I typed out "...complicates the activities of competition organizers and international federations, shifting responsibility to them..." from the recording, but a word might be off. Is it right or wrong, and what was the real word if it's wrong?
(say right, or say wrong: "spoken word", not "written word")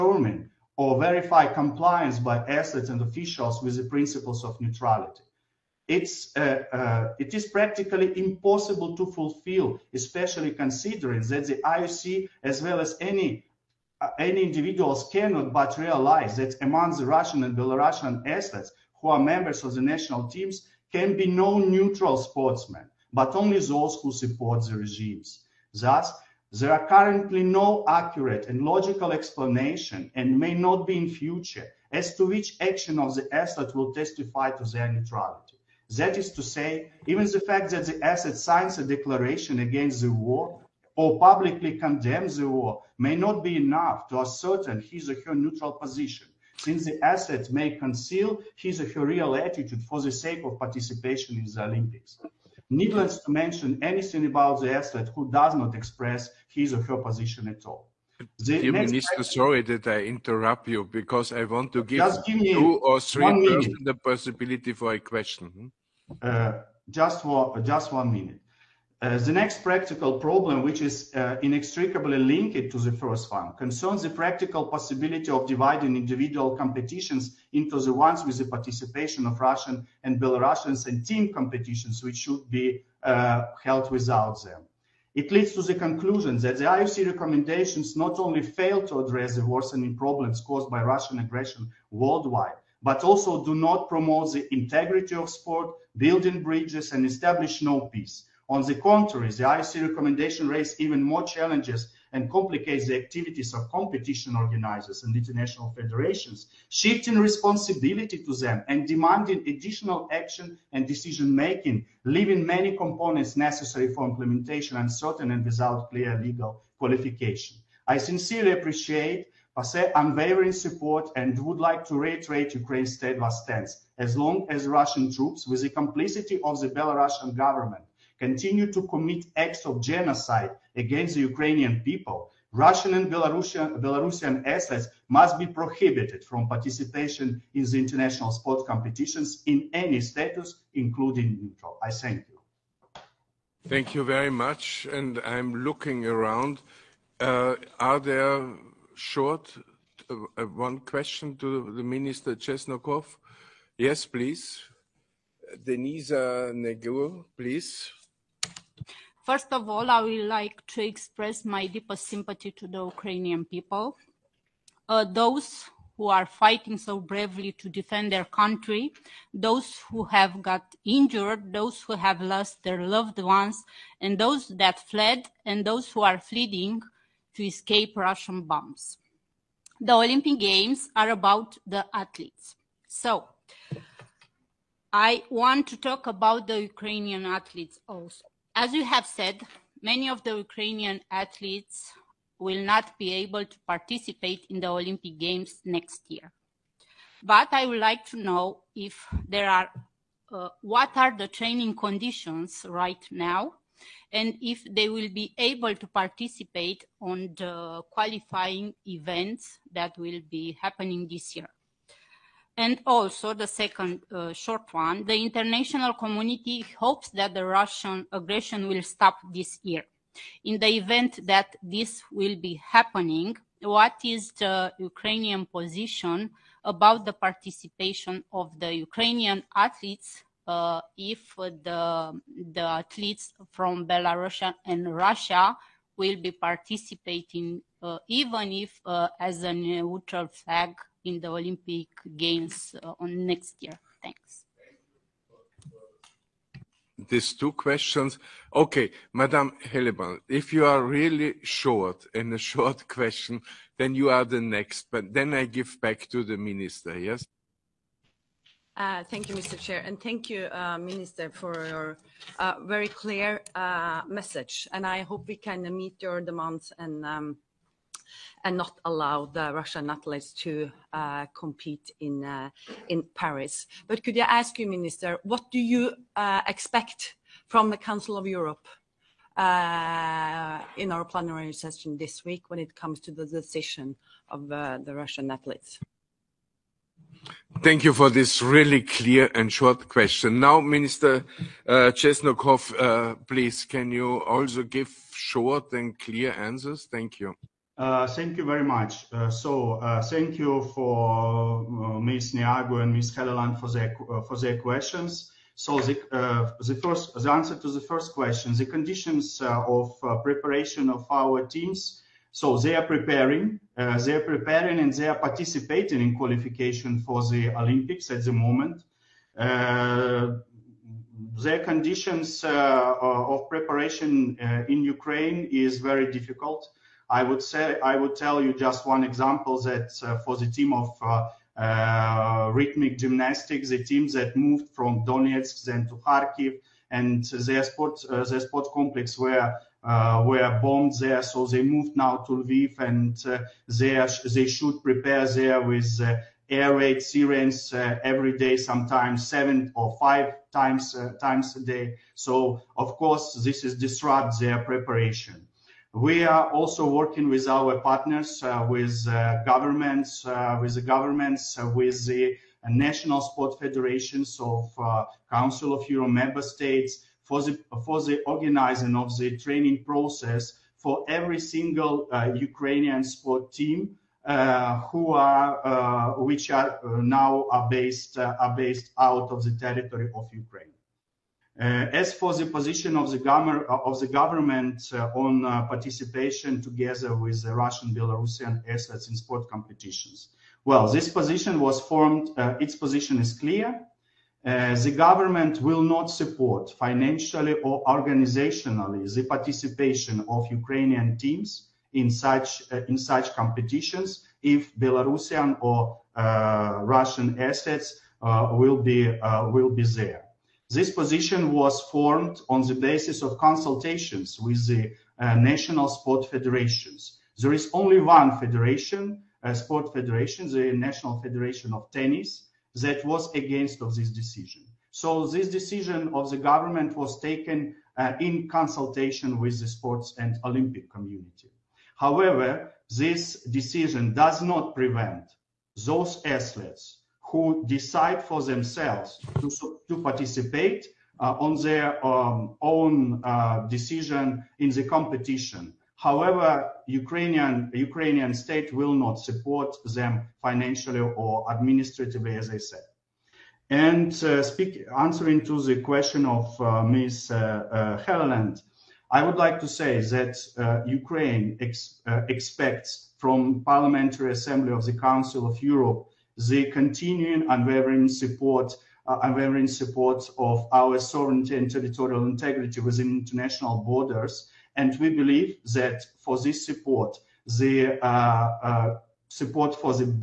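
right.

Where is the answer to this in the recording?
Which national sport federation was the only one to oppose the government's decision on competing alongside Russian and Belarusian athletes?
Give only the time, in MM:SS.
07:00.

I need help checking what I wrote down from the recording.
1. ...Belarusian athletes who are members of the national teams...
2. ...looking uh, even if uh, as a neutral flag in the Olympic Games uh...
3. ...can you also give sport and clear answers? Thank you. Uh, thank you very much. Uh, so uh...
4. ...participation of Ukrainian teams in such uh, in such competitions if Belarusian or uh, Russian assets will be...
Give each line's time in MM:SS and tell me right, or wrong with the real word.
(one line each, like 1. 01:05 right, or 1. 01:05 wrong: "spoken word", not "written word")
1. 00:17 right
2. 03:56 wrong: "participating", not "looking"
3. 04:53 wrong: "short", not "sport"
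4. 06:39 right.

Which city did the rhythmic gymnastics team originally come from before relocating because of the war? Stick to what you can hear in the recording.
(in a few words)
Donetsk.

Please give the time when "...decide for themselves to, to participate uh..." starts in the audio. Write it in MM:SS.
07:17.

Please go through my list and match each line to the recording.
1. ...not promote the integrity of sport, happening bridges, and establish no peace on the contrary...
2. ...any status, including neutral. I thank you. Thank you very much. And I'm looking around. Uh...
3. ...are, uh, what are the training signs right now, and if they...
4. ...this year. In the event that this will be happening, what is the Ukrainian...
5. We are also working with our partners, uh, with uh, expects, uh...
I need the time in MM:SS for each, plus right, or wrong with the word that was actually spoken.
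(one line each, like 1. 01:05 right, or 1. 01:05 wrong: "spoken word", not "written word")
1. 01:33 wrong: "building", not "happening"
2. 02:19 right
3. 03:19 wrong: "conditions", not "signs"
4. 03:39 right
5. 05:55 wrong: "governments", not "expects".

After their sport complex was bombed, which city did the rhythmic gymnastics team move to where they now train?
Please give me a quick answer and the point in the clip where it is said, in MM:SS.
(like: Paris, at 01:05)
Lviv, at 05:42.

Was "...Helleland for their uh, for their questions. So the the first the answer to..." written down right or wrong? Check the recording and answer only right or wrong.
right.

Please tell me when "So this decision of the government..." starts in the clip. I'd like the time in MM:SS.
07:04.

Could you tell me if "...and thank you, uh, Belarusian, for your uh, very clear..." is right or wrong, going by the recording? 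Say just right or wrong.
wrong.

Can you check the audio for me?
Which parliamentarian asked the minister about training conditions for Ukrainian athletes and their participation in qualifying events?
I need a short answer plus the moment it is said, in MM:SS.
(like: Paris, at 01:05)
Denisa Neagu, at 02:35.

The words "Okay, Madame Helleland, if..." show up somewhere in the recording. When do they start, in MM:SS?
04:08.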